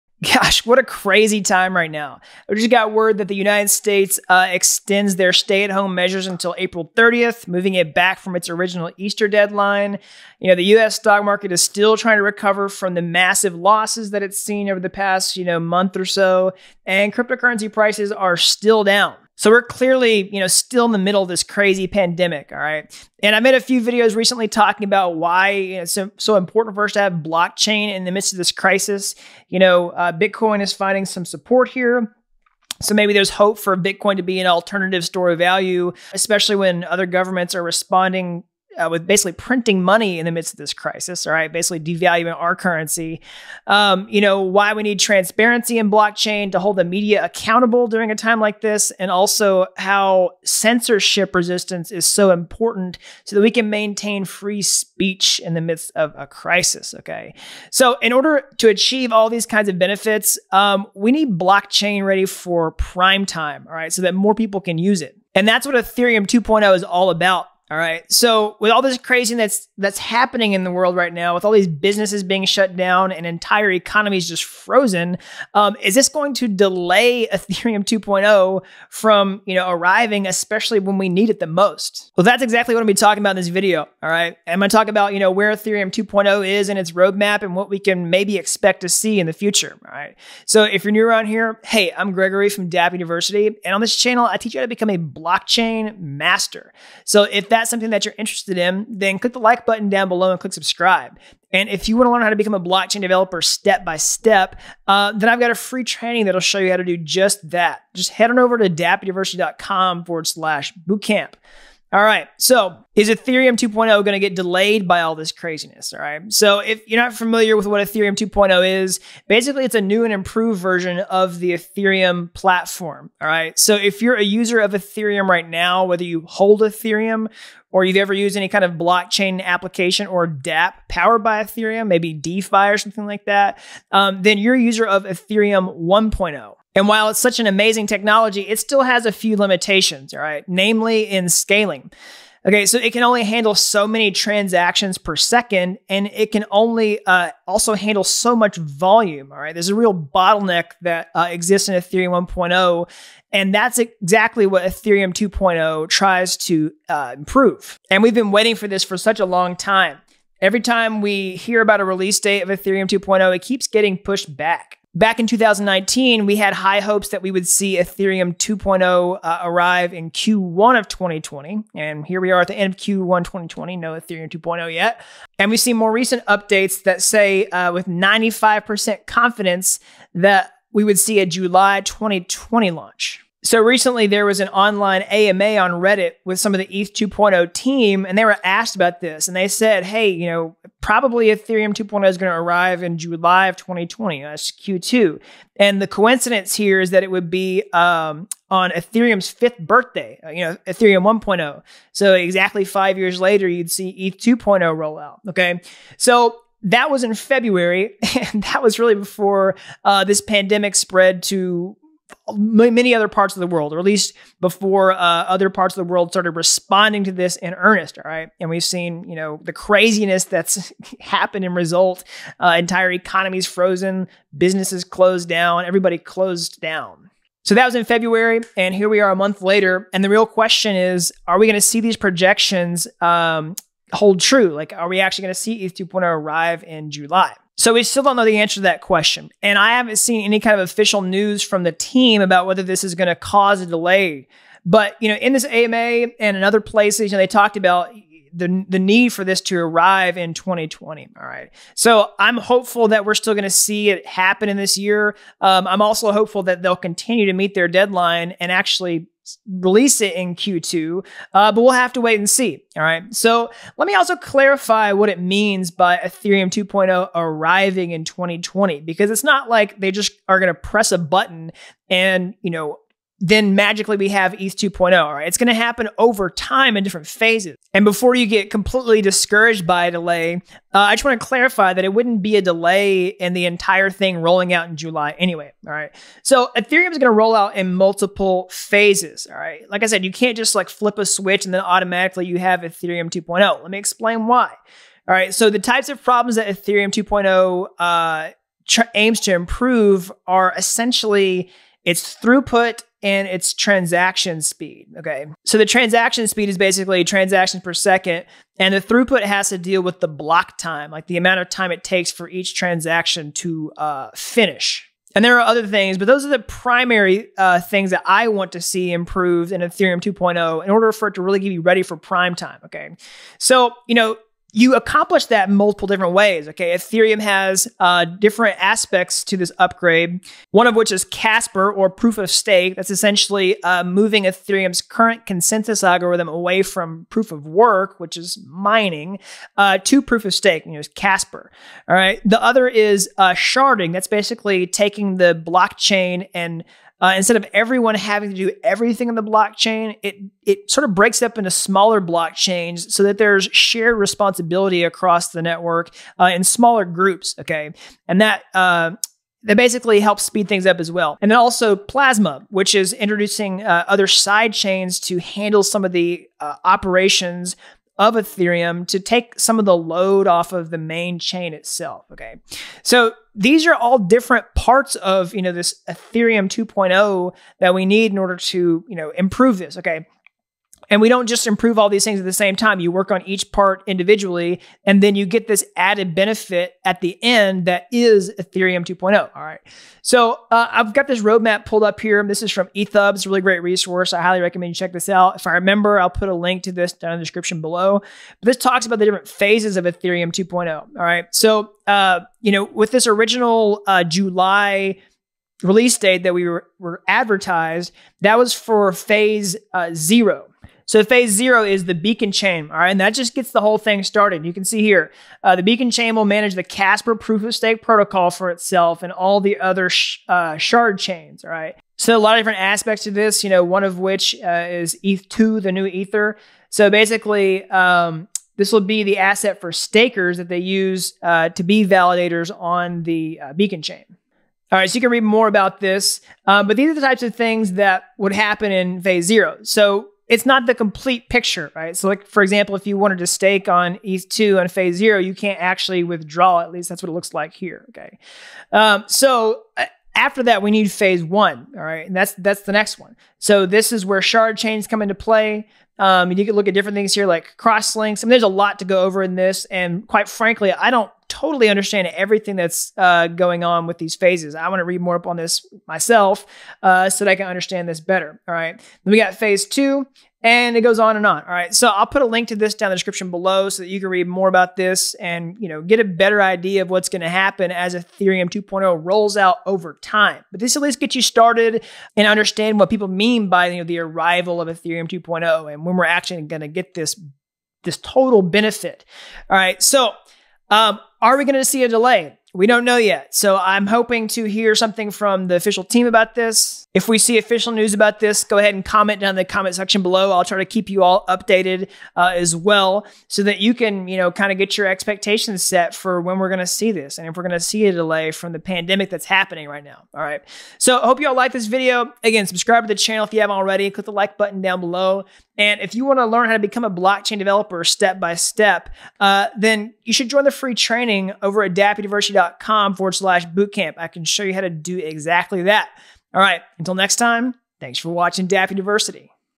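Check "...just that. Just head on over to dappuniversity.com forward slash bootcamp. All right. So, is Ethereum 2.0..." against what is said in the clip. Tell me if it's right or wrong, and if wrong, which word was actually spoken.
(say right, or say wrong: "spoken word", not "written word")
right.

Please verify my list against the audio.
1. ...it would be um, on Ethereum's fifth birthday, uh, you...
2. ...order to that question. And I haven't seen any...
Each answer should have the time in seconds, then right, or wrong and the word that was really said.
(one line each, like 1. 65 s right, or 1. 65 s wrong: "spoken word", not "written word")
1. 197 s right
2. 238 s wrong: "answer", not "order".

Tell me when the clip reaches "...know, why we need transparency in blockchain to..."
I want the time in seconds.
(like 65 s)
44 s.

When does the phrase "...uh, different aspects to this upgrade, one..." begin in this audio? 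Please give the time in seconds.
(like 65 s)
327 s.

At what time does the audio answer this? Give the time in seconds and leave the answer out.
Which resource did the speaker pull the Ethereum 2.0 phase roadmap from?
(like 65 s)
392 s.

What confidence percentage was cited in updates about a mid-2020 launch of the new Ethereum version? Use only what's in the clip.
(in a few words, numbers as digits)
95%.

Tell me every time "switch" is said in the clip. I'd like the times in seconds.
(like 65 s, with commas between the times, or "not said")
291 s.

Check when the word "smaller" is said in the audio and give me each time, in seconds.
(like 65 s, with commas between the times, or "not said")
351 s, 356 s.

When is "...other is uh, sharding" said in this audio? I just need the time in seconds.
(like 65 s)
342 s.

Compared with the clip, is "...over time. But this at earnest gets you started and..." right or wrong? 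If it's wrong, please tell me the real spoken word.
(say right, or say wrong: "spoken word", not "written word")
wrong: "least", not "earnest".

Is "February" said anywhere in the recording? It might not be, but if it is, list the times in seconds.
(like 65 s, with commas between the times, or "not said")
207 s, 227 s.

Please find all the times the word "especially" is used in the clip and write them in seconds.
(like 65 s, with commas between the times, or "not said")
36 s, 80 s.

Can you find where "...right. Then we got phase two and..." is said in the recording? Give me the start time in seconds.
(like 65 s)
468 s.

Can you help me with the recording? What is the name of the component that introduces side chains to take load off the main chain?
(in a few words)
Plasma.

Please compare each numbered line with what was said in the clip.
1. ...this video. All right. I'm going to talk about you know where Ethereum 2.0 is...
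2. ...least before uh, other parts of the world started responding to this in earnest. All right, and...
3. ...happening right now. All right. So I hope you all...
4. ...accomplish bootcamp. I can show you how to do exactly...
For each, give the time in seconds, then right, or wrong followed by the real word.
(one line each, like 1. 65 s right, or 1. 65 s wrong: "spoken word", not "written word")
1. 83 s right
2. 213 s right
3. 509 s right
4. 523 s wrong: "slash", not "accomplish".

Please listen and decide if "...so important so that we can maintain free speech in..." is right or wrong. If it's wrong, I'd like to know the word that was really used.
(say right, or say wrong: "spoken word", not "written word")
right.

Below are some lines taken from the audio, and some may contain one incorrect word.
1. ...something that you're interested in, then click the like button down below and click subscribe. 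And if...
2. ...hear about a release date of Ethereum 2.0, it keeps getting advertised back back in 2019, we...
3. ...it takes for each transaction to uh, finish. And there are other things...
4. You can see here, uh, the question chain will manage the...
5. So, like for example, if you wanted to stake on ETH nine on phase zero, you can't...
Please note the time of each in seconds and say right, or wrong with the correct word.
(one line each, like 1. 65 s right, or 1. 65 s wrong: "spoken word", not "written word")
1. 97 s right
2. 161 s wrong: "pushed", not "advertised"
3. 311 s right
4. 414 s wrong: "beacon", not "question"
5. 441 s wrong: "two", not "nine".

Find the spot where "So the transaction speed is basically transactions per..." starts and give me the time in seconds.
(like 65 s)
305 s.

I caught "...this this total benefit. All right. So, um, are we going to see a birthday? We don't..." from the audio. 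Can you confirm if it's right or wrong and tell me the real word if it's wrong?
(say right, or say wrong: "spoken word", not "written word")
wrong: "delay", not "birthday".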